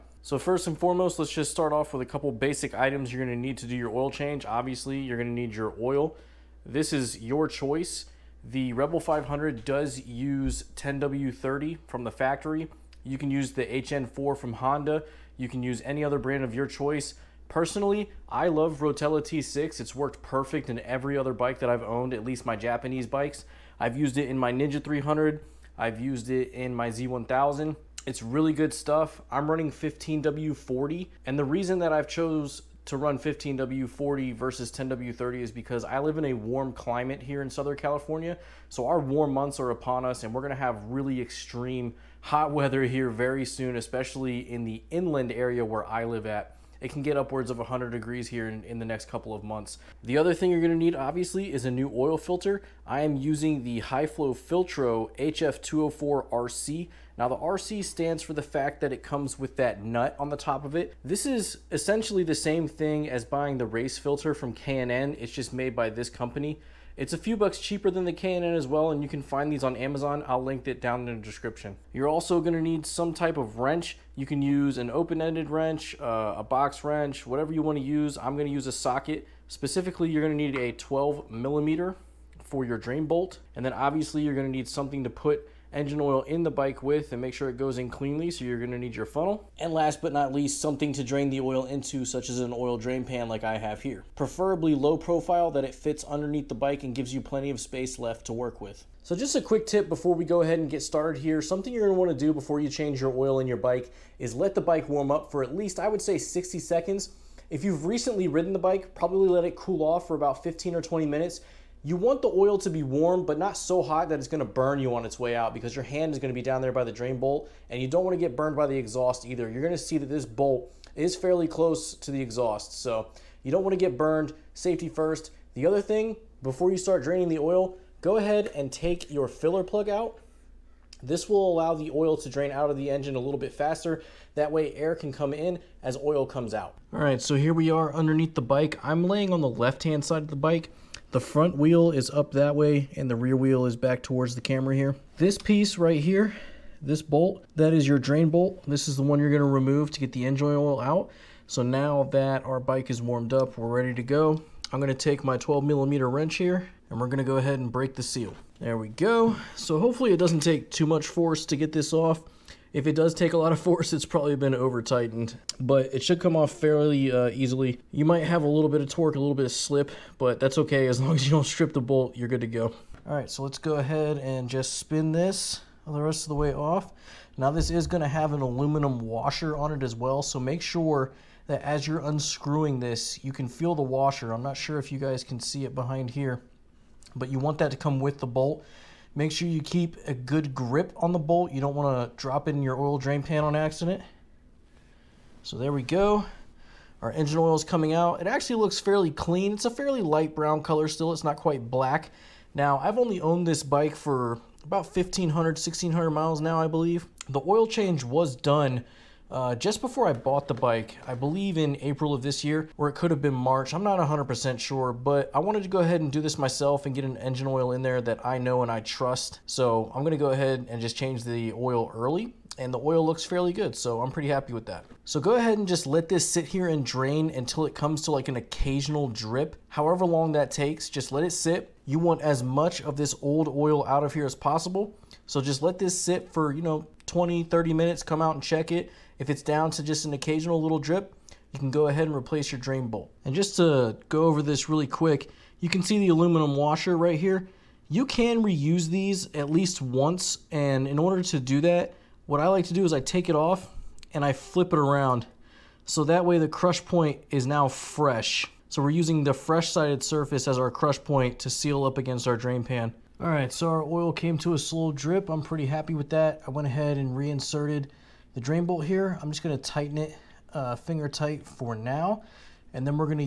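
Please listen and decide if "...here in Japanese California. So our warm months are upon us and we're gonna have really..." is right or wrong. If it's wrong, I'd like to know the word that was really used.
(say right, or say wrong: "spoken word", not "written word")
wrong: "Southern", not "Japanese".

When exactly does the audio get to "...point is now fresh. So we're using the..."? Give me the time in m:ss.
4:16.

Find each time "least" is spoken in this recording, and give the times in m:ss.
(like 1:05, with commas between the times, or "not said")
0:22, 1:30, 1:45, 4:09.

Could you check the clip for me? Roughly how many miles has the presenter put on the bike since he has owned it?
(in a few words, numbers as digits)
1,500 to 1,600 miles.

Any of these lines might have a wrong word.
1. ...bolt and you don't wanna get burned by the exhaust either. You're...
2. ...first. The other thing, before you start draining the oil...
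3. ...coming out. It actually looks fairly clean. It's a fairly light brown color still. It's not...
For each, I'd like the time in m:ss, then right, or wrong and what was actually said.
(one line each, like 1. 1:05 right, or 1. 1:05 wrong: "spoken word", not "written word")
1. 1:57 right
2. 2:04 right
3. 3:17 right.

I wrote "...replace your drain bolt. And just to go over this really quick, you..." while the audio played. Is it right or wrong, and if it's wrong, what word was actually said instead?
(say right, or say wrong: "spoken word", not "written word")
right.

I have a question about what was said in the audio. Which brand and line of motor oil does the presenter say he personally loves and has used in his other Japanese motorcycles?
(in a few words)
Rotella T6.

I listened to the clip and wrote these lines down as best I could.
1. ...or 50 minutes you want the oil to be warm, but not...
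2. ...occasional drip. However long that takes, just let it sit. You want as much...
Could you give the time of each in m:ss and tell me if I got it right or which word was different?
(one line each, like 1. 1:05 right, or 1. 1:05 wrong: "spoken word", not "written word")
1. 1:50 wrong: "20", not "50"
2. 3:48 right.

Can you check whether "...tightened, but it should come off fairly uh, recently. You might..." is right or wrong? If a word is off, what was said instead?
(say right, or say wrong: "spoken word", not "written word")
wrong: "easily", not "recently".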